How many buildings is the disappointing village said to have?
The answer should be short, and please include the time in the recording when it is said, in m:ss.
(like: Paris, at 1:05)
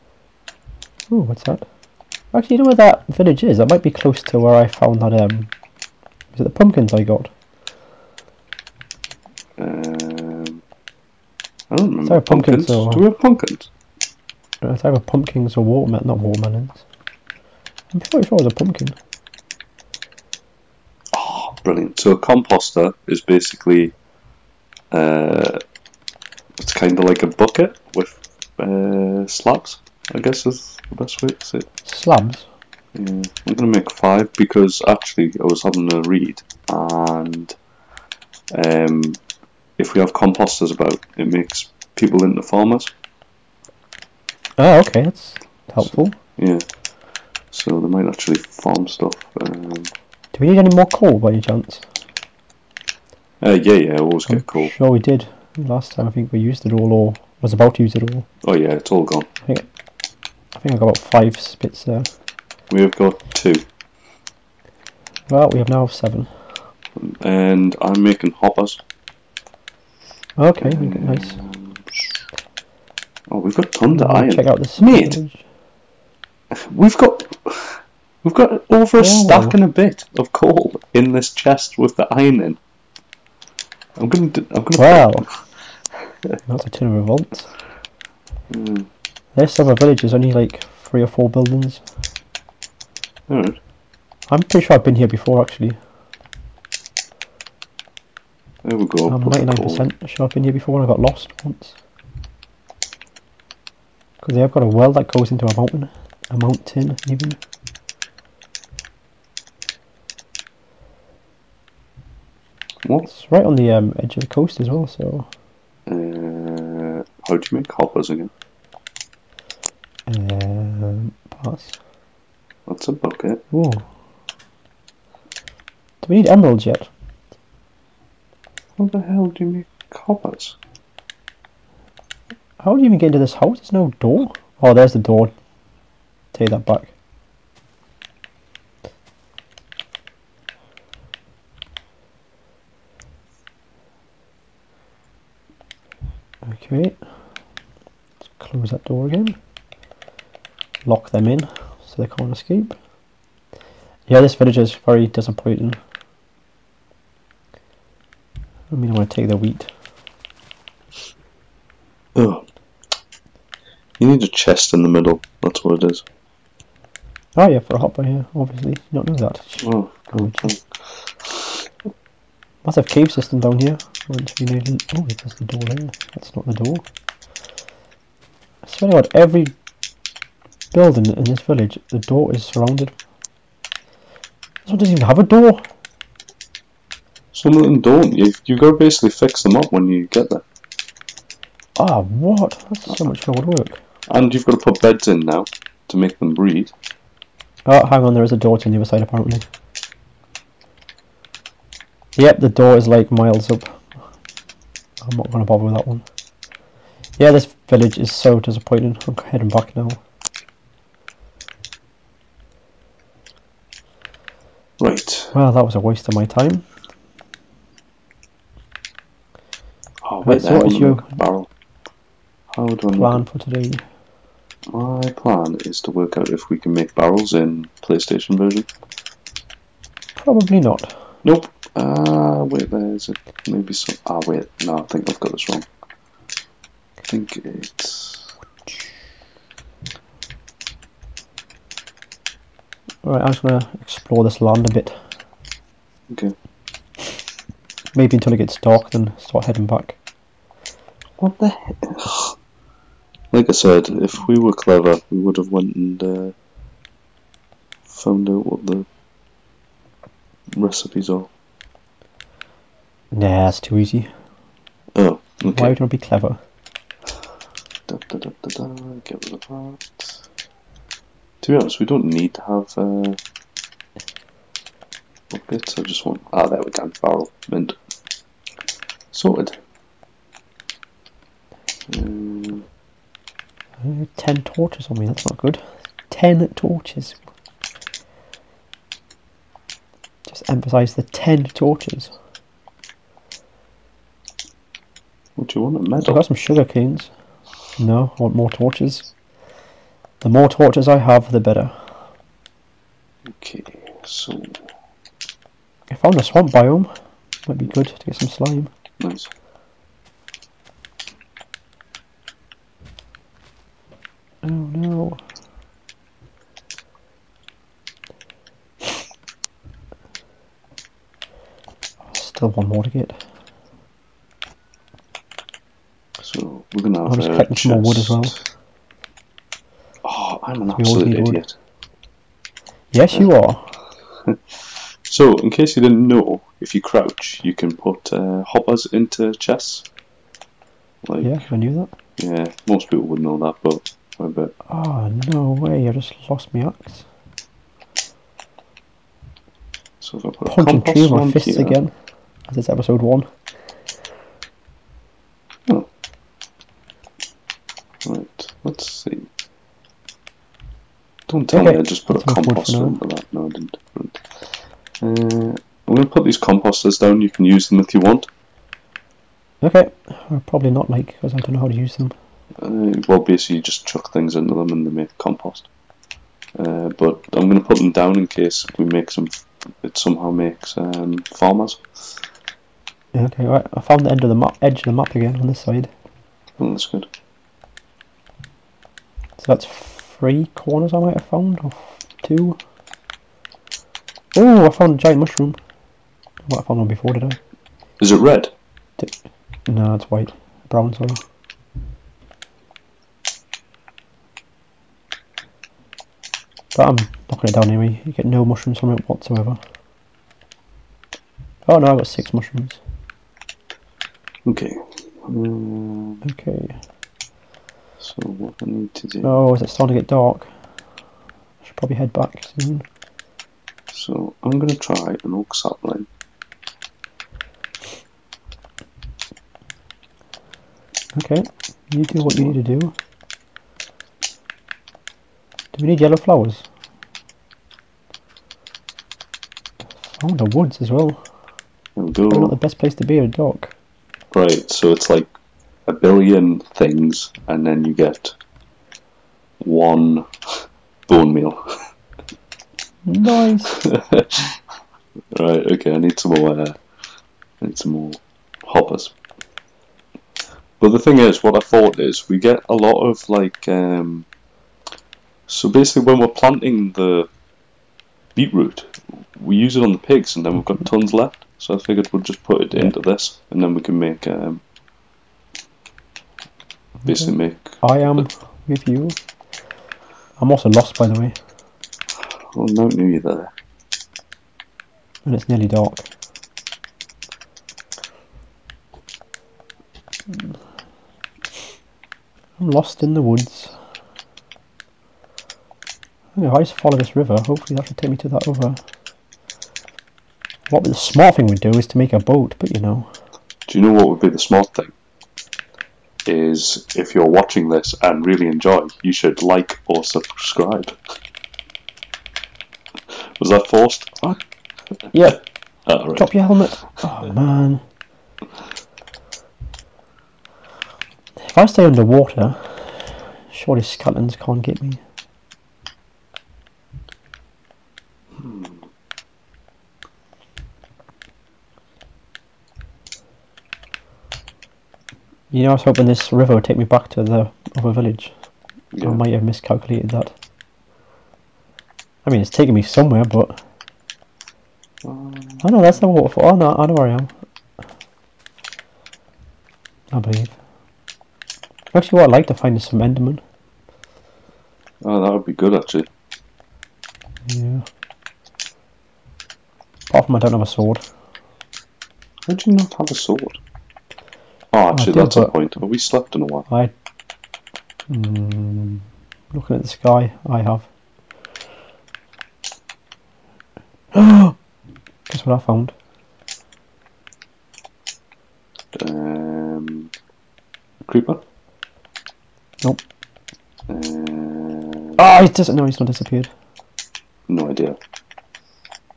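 three or four, at 1:30.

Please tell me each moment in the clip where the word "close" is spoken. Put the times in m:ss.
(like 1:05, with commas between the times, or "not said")
0:03, 2:28.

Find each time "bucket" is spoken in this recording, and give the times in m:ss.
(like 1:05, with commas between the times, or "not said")
0:27, 2:02, 4:35.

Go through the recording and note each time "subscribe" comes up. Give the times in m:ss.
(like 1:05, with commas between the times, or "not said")
8:30.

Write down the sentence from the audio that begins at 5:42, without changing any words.
Yeah, most people would know that, but actually, Oh, no way, I just lost my axe.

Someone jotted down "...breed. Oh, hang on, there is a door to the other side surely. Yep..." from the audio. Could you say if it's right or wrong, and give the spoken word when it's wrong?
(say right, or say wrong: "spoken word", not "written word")
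wrong: "apparently", not "surely".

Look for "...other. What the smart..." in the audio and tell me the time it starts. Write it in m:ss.
8:18.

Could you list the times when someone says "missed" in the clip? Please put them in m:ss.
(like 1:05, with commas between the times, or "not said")
not said.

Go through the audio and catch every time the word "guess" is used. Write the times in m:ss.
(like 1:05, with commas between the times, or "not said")
0:30, 9:35.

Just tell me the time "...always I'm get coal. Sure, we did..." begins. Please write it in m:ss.
0:53.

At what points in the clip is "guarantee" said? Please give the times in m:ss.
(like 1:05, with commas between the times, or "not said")
not said.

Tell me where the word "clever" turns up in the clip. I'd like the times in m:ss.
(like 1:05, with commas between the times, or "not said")
4:14, 4:25.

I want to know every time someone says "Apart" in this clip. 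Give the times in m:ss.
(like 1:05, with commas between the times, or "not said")
9:20.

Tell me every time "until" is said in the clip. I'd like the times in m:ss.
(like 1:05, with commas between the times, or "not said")
4:08.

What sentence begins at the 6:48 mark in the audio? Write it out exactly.
You get no mushrooms from it whatsoever.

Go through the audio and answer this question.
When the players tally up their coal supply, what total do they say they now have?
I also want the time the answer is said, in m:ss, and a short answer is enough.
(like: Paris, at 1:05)
7, at 1:05.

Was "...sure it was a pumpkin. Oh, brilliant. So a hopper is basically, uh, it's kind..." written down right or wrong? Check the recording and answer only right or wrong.
wrong.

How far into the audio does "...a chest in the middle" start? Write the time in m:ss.
2:44.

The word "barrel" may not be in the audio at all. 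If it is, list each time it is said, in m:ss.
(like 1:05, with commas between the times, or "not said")
3:41, 3:46, 4:37.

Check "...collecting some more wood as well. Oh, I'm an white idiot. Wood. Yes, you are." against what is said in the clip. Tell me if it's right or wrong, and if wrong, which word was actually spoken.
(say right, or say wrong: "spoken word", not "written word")
wrong: "absolute", not "white".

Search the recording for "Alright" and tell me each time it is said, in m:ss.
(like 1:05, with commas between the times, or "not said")
1:33, 4:03.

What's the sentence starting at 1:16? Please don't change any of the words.
We've got we've got over a oh.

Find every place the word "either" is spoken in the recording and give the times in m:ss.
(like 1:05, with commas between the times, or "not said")
0:14, 8:03.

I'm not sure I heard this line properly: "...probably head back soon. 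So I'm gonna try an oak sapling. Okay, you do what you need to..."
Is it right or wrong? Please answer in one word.
right.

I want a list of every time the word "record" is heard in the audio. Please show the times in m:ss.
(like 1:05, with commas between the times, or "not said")
not said.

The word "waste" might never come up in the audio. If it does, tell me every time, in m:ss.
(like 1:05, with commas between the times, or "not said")
3:35.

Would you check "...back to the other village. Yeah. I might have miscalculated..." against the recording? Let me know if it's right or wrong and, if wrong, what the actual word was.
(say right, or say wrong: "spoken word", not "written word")
right.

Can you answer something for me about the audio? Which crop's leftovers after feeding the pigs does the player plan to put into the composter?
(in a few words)
beetroot.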